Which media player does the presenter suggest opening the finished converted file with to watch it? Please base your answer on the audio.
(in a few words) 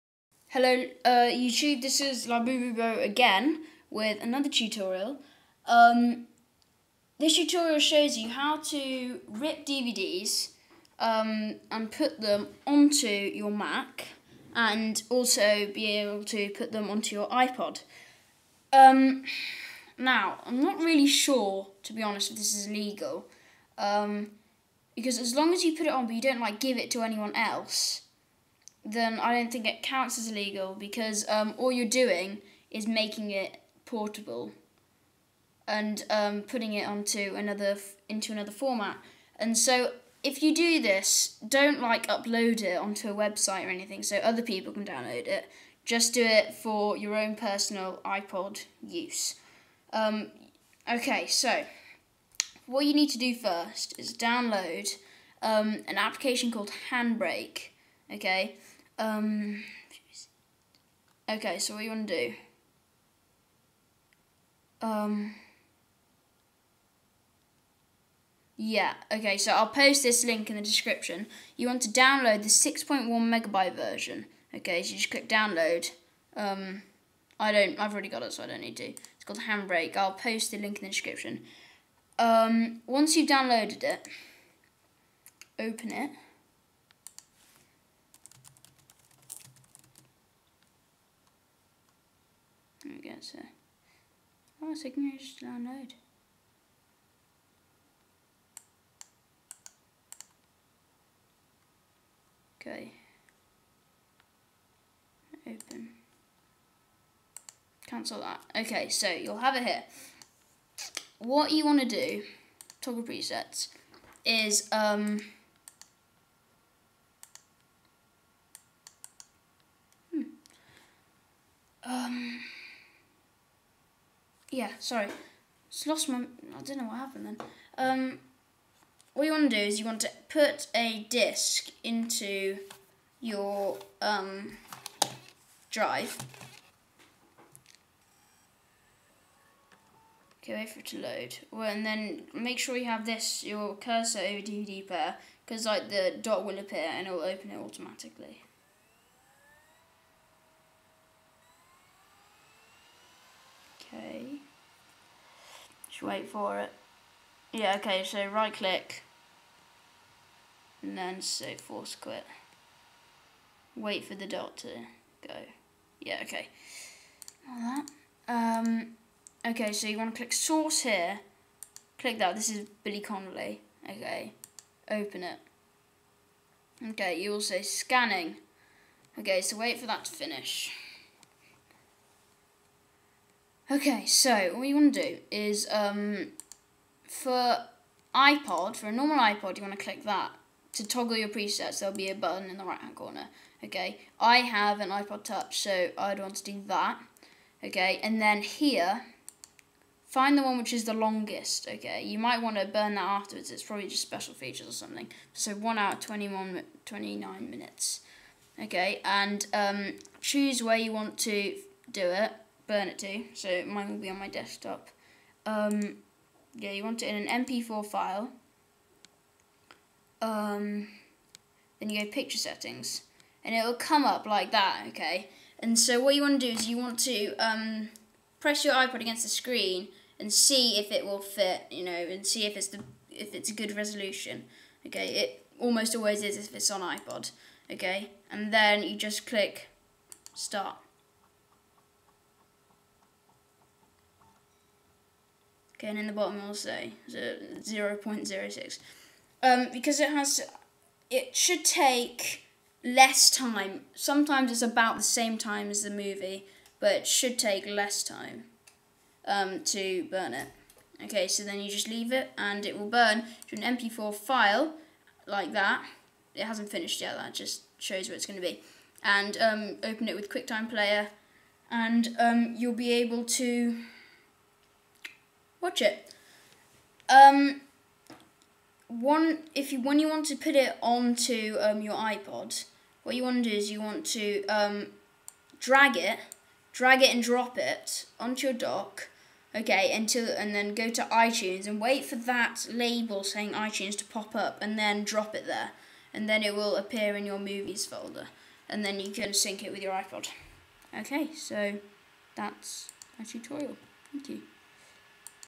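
QuickTime Player.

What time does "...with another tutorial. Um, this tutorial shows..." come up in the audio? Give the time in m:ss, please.
0:03.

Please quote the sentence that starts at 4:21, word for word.
Okay, so then you just leave it and it will burn to an MP4 file like that.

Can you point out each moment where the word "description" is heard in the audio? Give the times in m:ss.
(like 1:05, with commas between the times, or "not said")
1:10, 1:20.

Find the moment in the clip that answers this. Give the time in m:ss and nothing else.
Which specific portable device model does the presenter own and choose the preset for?
3:14.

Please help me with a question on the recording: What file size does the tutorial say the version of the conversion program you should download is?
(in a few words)
6.1 megabytes.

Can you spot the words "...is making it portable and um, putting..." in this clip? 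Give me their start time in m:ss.
0:32.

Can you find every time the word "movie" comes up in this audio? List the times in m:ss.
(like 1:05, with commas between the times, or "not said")
4:15, 4:57.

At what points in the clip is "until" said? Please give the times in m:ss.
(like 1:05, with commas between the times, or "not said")
4:49.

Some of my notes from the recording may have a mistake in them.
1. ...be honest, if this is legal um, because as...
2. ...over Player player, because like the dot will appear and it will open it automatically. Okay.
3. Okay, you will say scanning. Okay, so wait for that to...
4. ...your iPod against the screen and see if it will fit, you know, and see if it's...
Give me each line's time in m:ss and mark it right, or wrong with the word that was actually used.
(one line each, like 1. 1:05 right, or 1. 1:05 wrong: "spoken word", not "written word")
1. 0:21 right
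2. 2:24 wrong: "DVD", not "Player"
3. 2:56 right
4. 3:48 right.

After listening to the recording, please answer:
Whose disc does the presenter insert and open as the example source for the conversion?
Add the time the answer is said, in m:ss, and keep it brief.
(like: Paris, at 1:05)
Billy Connolly, at 2:52.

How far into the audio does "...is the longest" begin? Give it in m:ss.
3:20.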